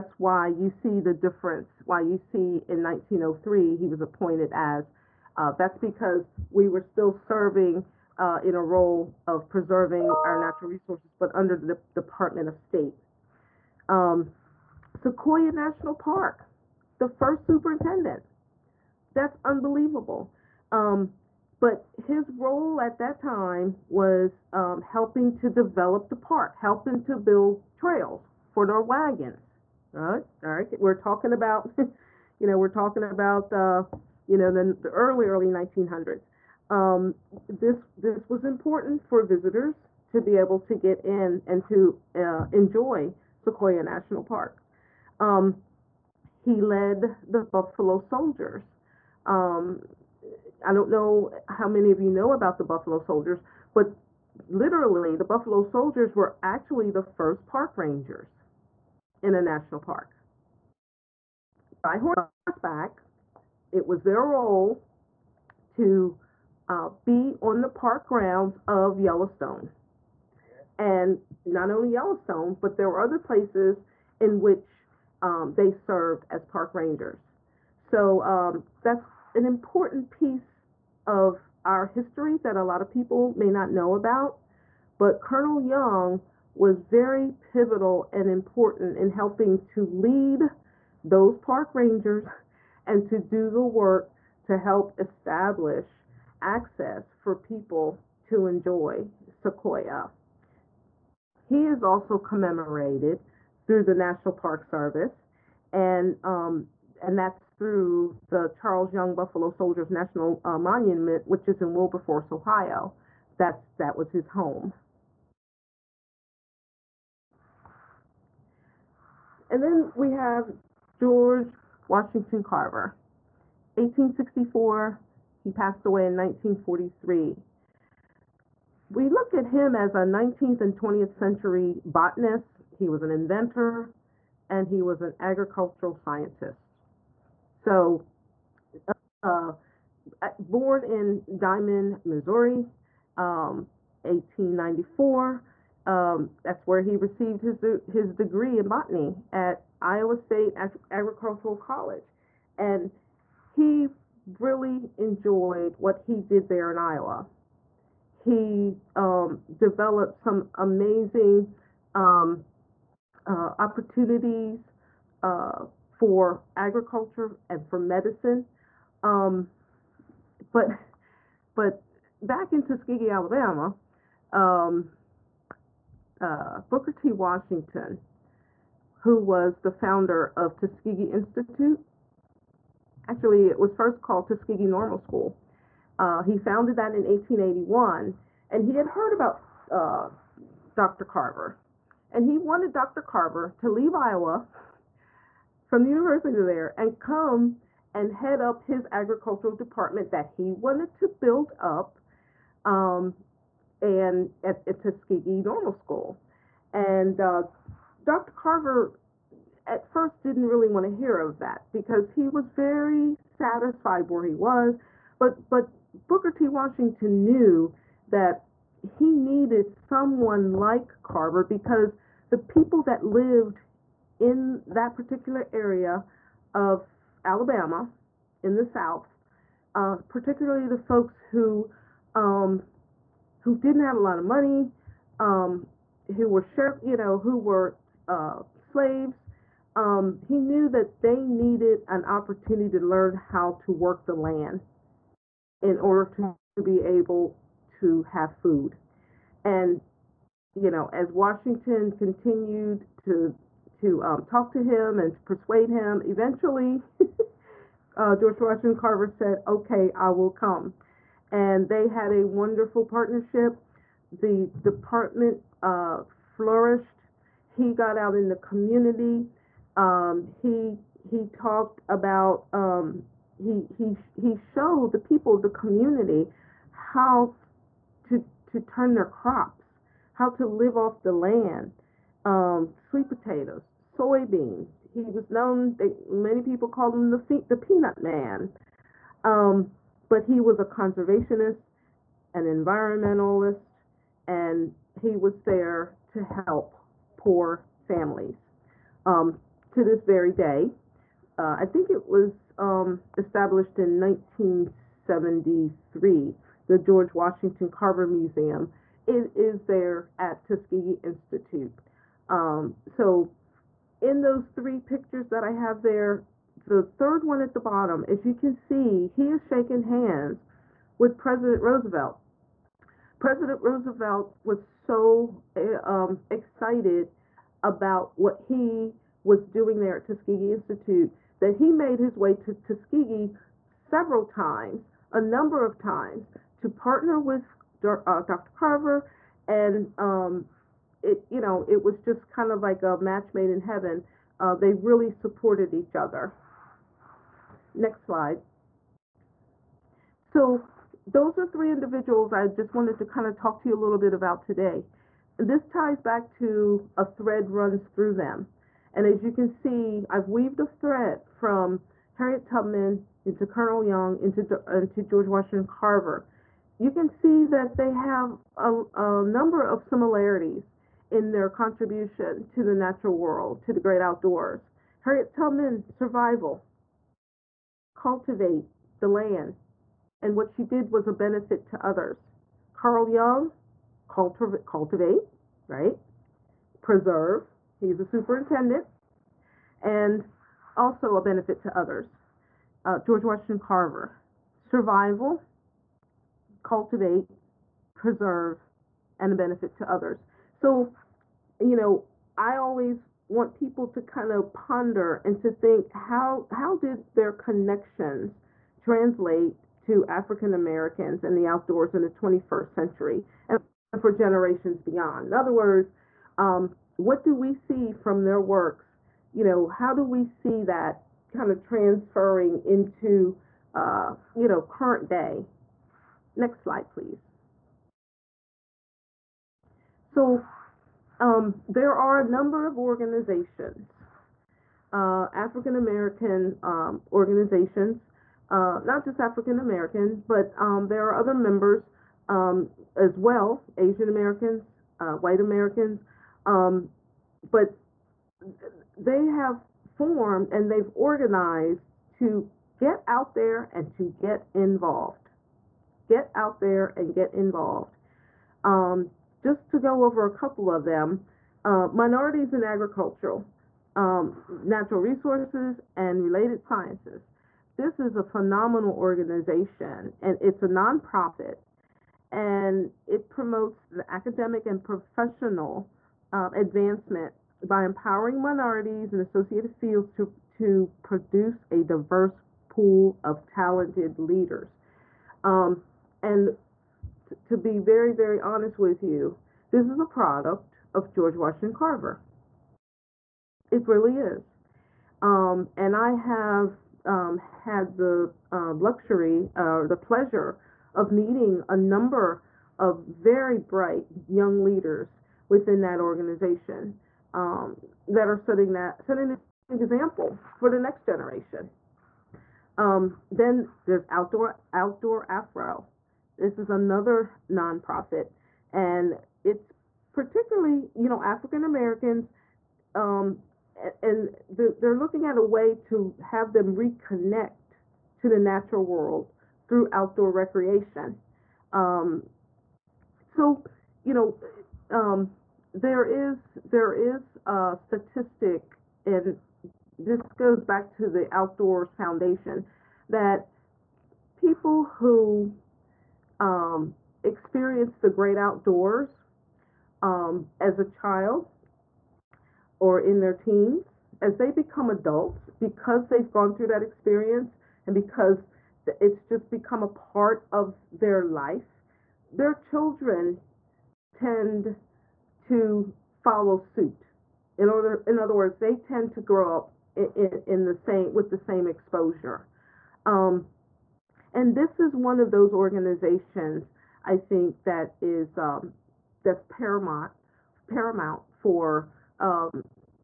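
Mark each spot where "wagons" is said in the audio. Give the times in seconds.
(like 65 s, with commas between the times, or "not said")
28 s.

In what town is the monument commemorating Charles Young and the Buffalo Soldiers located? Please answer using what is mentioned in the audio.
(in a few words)
Wilberforce, Ohio.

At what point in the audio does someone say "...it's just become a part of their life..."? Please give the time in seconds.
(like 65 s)
558 s.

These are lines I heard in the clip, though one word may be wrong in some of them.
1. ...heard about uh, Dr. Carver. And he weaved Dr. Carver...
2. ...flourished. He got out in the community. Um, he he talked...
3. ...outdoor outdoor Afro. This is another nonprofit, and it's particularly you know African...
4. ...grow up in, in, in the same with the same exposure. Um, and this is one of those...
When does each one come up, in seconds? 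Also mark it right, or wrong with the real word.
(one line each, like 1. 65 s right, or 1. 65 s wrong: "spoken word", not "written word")
1. 188 s wrong: "wanted", not "weaved"
2. 266 s right
3. 514 s right
4. 569 s right.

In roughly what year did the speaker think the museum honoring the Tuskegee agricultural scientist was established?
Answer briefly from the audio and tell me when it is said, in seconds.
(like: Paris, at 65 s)
1973, at 303 s.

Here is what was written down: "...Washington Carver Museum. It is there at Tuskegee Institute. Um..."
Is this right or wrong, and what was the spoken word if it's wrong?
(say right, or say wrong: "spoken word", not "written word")
right.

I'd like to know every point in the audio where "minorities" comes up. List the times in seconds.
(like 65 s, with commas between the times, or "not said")
461 s, 478 s.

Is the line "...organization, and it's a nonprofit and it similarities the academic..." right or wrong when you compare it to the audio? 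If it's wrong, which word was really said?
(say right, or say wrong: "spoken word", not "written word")
wrong: "promotes", not "similarities".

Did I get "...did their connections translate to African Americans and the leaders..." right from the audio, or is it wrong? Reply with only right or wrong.
wrong.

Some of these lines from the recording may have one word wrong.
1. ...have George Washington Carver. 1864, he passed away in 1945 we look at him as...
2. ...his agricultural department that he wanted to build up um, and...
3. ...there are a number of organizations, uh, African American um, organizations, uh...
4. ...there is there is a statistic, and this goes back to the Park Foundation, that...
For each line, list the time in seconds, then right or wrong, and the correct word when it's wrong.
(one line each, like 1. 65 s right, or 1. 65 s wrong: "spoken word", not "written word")
1. 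120 s wrong: "1943", not "1945"
2. 198 s right
3. 431 s right
4. 535 s wrong: "Outdoors", not "Park".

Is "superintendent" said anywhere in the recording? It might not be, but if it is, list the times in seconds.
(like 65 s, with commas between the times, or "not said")
17 s, 388 s.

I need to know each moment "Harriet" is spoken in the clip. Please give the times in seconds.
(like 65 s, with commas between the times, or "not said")
362 s, 374 s.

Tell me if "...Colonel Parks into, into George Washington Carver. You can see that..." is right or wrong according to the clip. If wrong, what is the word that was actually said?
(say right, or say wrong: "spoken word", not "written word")
wrong: "Young", not "Parks".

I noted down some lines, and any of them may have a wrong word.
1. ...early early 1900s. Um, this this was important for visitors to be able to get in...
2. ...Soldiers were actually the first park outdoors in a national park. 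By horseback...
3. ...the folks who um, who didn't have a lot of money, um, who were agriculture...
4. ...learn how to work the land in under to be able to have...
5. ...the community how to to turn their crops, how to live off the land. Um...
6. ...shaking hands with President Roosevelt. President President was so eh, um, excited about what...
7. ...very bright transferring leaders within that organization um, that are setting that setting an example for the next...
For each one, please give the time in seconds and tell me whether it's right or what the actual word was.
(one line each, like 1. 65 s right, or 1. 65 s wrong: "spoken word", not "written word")
1. 34 s right
2. 55 s wrong: "rangers", not "outdoors"
3. 230 s wrong: "share", not "agriculture"
4. 242 s wrong: "order", not "under"
5. 275 s right
6. 319 s wrong: "Roosevelt", not "President"
7. 503 s wrong: "young", not "transferring".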